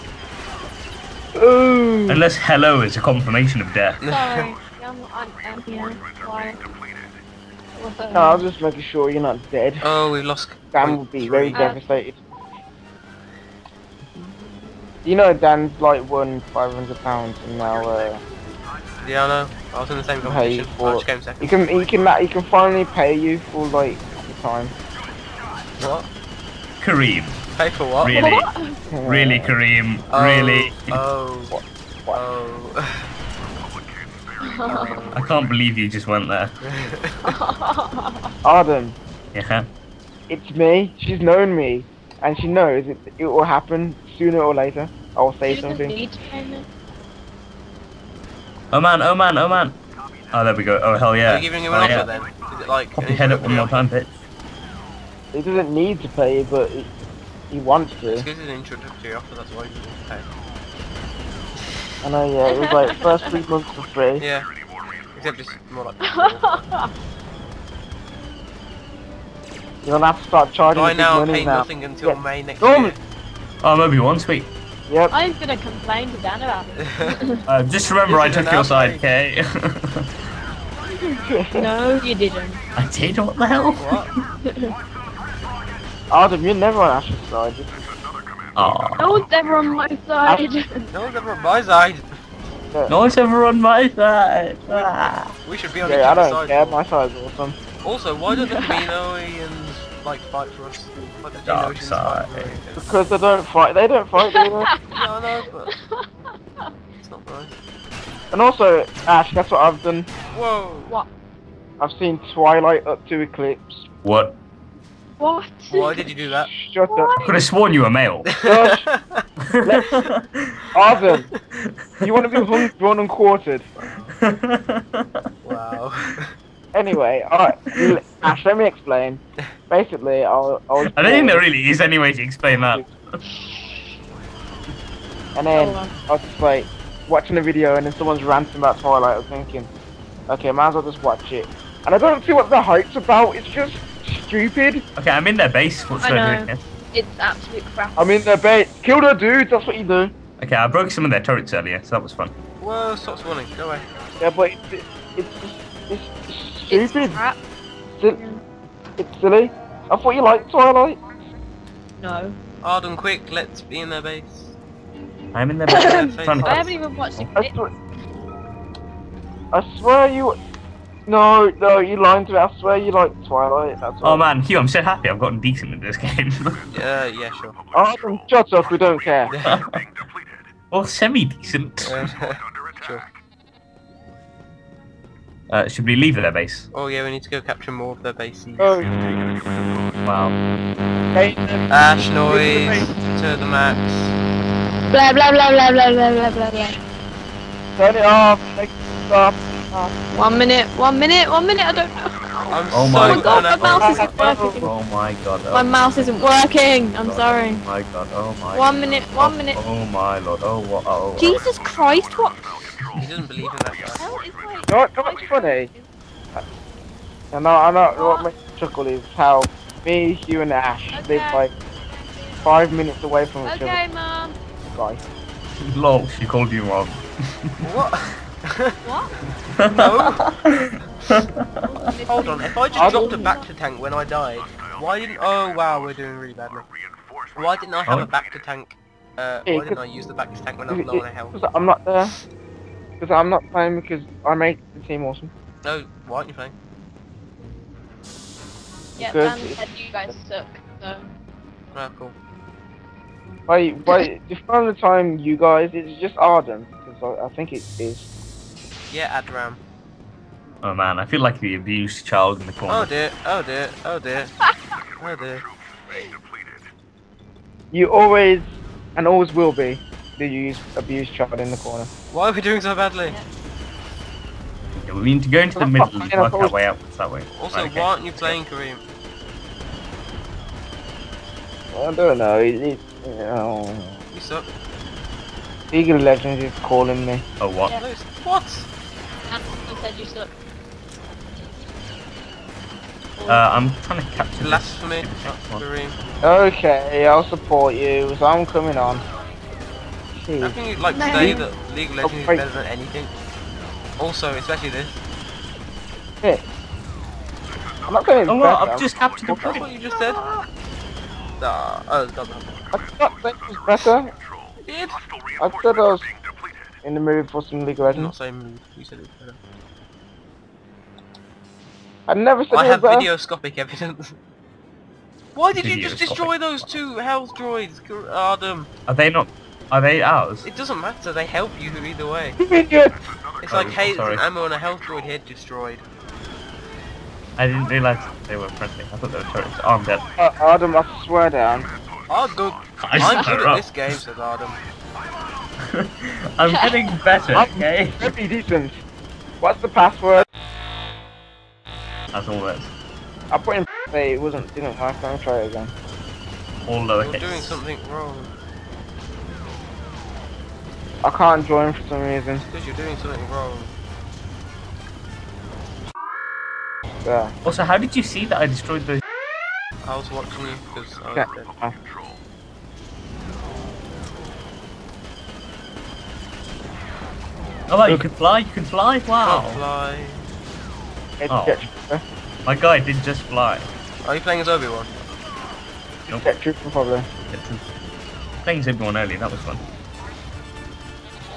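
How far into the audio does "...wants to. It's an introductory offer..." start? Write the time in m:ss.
0:57.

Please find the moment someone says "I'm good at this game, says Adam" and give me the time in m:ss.
5:42.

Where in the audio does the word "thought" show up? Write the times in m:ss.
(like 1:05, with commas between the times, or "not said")
2:39, 5:12, 5:38.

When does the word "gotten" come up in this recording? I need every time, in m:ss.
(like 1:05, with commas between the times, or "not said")
2:55.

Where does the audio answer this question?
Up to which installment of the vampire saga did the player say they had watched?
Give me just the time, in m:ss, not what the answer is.
1:53.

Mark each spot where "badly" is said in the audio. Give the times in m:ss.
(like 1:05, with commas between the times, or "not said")
3:56, 4:32.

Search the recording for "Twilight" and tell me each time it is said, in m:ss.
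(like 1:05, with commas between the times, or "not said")
1:52, 2:18, 2:40, 2:53.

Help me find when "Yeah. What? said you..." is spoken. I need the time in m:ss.
4:47.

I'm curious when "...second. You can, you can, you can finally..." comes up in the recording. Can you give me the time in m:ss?
0:21.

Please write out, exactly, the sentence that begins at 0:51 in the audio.
Are you giving him an oh, offer then?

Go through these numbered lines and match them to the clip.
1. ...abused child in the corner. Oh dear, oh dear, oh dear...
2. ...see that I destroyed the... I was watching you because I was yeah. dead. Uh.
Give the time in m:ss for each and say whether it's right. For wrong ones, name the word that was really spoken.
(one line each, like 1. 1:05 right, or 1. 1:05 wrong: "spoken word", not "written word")
1. 4:21 right
2. 6:08 right.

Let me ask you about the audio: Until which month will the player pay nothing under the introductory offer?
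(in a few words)
May.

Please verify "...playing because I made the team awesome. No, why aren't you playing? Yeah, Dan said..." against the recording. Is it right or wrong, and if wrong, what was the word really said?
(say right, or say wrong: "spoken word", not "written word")
right.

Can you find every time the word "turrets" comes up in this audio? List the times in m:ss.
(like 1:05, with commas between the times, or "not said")
2:31, 5:39.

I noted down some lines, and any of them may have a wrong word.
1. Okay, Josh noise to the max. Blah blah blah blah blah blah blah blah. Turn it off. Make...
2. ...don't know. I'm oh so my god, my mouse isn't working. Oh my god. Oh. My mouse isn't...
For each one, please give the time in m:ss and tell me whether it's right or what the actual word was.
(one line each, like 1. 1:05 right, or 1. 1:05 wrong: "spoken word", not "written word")
1. 3:11 wrong: "Ash", not "Josh"
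2. 3:21 right.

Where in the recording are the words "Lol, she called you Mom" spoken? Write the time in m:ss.
3:45.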